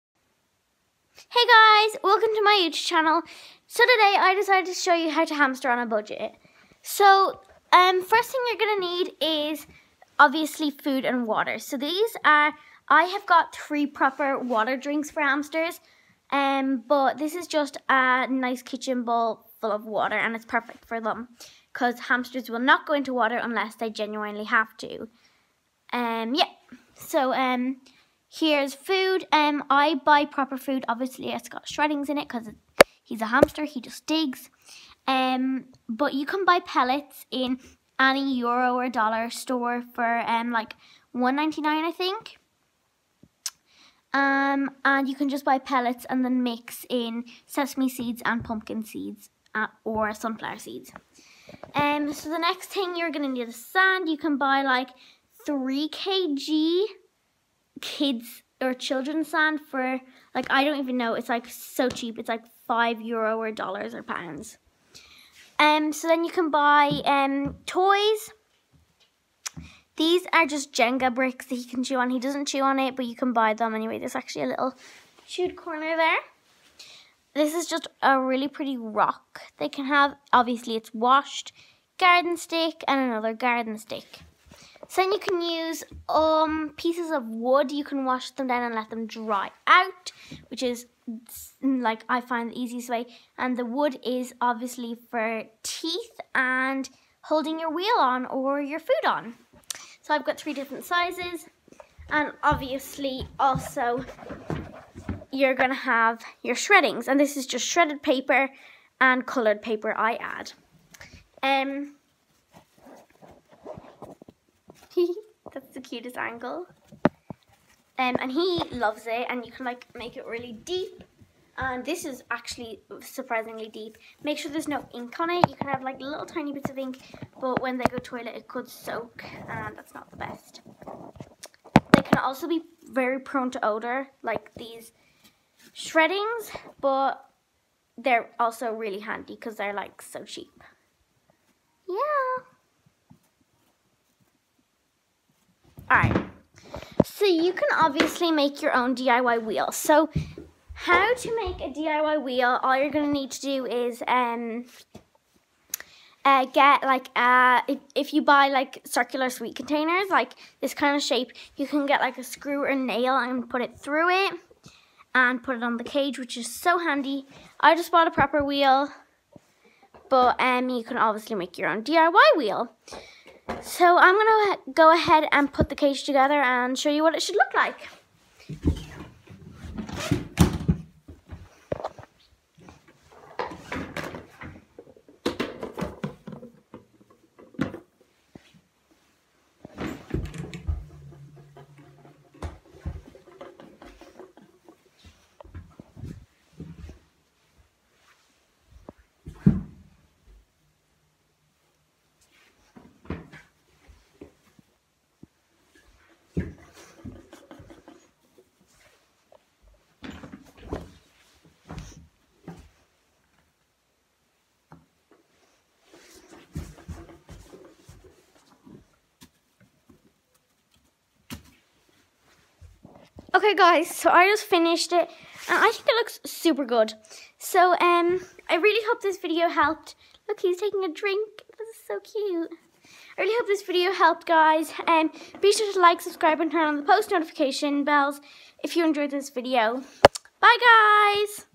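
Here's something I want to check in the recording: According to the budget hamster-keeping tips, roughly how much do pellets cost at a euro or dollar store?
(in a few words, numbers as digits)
1.99.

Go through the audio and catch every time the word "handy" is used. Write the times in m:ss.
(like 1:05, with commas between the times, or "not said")
2:18, 2:46.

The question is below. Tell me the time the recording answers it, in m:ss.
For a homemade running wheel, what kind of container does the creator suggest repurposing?
2:38.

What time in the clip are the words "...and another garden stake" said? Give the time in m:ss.
1:22.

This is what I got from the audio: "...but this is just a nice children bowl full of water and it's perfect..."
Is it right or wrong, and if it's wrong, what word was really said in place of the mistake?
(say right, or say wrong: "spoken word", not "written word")
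wrong: "kitchen", not "children".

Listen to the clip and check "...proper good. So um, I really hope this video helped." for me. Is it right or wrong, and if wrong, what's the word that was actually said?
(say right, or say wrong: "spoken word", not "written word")
wrong: "super", not "proper".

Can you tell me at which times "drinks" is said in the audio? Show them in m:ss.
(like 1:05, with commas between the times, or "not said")
0:14, 3:50.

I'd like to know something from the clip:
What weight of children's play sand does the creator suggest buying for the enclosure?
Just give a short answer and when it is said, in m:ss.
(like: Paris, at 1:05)
3 kg, at 0:55.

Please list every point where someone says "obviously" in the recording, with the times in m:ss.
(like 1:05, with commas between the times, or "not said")
0:10, 0:30, 1:20, 1:34, 1:42, 2:27, 2:50.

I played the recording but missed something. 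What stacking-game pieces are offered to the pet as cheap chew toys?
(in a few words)
Jenga bricks.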